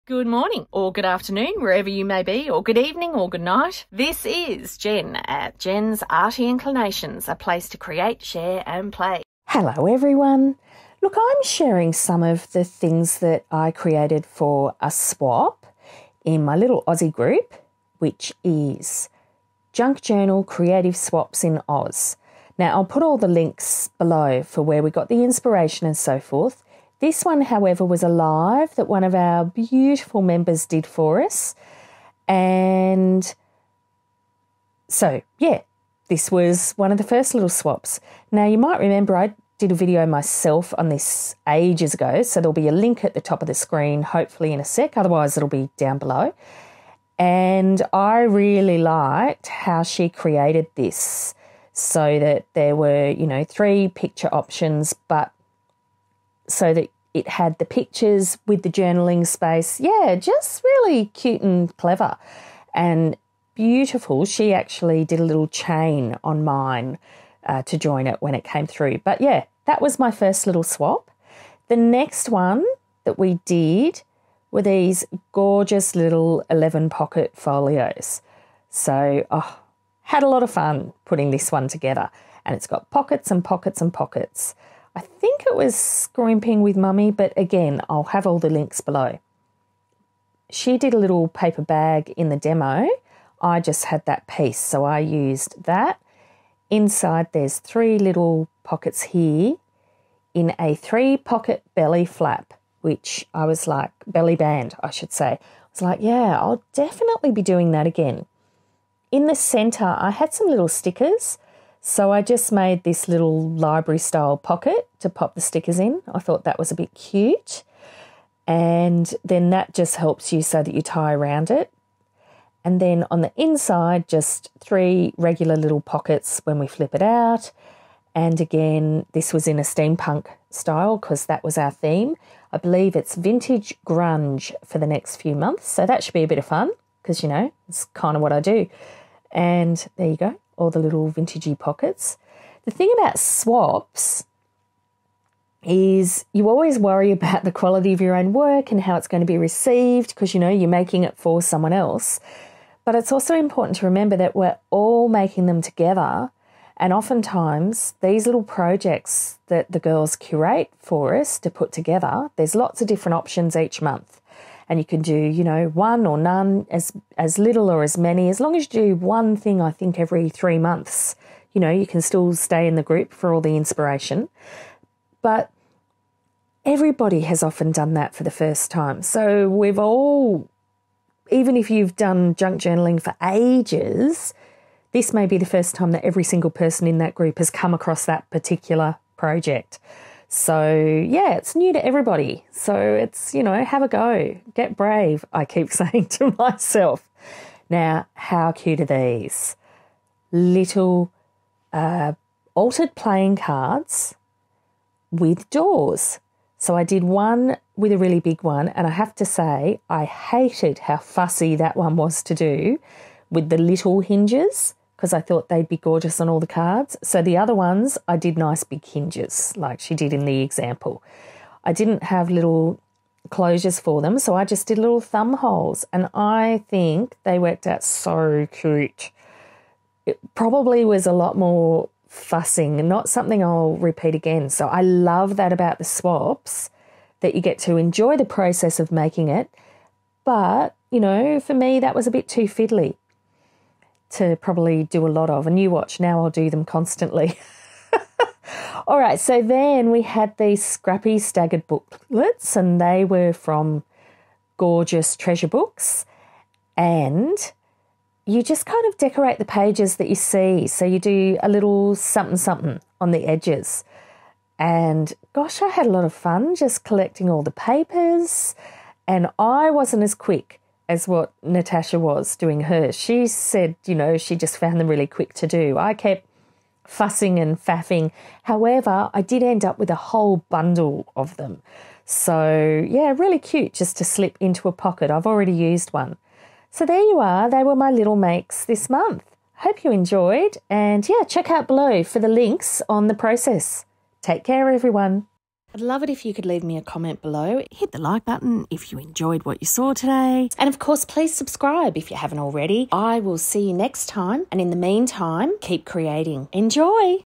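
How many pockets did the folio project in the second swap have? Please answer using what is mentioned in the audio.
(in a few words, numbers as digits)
11.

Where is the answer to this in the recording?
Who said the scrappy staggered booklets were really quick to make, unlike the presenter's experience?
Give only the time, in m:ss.
4:31.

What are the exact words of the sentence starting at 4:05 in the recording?
And you watch now, I'll do them constantly.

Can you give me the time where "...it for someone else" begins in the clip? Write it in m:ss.
2:31.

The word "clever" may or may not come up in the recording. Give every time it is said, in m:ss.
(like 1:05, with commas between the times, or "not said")
1:01.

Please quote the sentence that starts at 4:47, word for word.
They were my little makes this month.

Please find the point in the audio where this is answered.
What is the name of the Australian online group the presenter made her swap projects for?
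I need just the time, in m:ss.
0:19.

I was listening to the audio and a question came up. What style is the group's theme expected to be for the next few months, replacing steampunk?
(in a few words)
vintage grunge.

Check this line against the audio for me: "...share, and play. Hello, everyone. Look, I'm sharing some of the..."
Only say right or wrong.
right.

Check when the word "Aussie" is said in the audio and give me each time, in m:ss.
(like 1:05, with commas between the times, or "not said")
0:16.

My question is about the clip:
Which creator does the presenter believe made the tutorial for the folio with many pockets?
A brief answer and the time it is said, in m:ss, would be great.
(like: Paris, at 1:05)
Scrimping with Mummy, at 1:25.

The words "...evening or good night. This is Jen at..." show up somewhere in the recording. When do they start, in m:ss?
0:02.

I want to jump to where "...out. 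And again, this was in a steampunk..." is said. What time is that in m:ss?
2:07.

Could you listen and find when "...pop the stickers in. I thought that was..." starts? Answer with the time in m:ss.
1:55.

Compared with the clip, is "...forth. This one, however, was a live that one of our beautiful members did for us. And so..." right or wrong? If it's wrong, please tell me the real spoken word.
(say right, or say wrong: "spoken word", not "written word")
right.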